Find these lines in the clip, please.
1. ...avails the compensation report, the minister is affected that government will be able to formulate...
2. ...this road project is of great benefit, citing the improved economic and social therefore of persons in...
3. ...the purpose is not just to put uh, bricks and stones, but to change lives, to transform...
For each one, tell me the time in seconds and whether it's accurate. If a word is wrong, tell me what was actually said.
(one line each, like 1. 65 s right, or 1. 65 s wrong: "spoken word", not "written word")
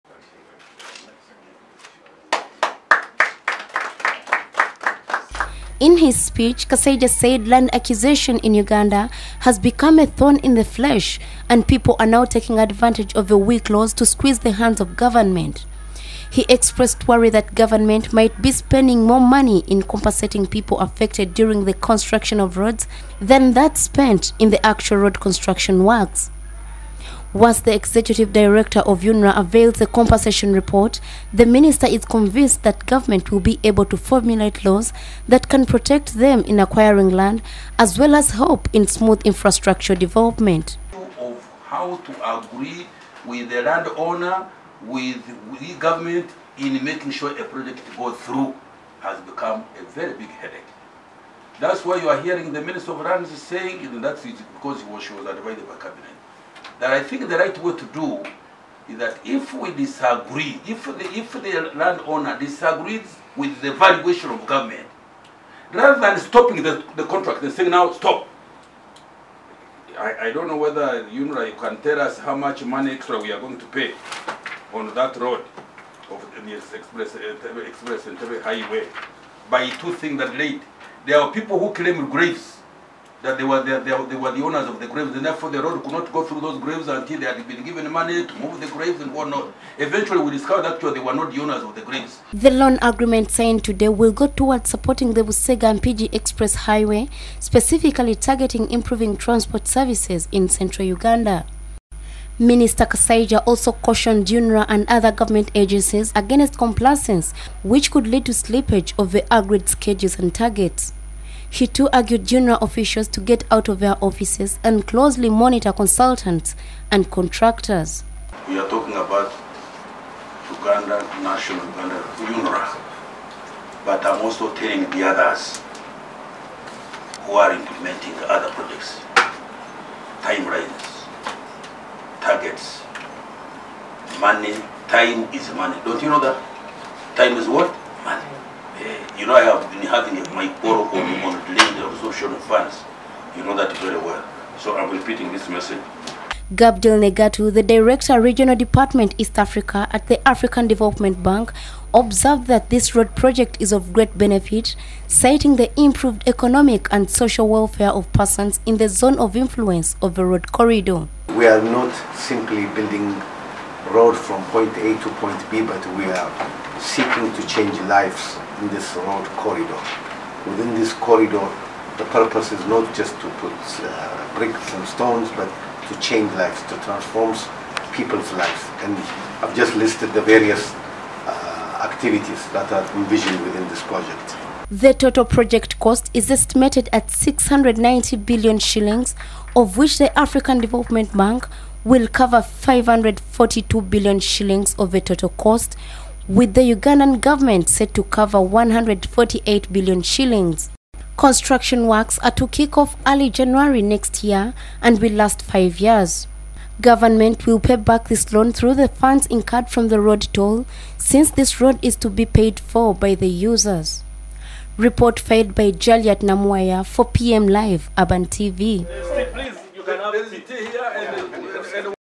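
1. 29 s wrong: "convinced", not "affected"
2. 152 s wrong: "welfare", not "therefore"
3. 171 s right.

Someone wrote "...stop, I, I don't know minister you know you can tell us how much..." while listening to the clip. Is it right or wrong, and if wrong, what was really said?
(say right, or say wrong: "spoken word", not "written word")
wrong: "whether", not "minister".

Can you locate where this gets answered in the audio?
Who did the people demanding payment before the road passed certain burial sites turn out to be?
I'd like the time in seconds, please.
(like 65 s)
90 s.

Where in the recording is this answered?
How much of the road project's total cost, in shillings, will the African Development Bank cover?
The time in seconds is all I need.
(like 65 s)
192 s.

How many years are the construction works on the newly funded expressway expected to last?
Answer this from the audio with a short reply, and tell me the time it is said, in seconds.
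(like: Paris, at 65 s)
5, at 205 s.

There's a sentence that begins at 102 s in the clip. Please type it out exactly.
Minister Kasaija also cautioned UNRA and other government agencies against complacence, which could lead to slippage of the agreed schedules and targets.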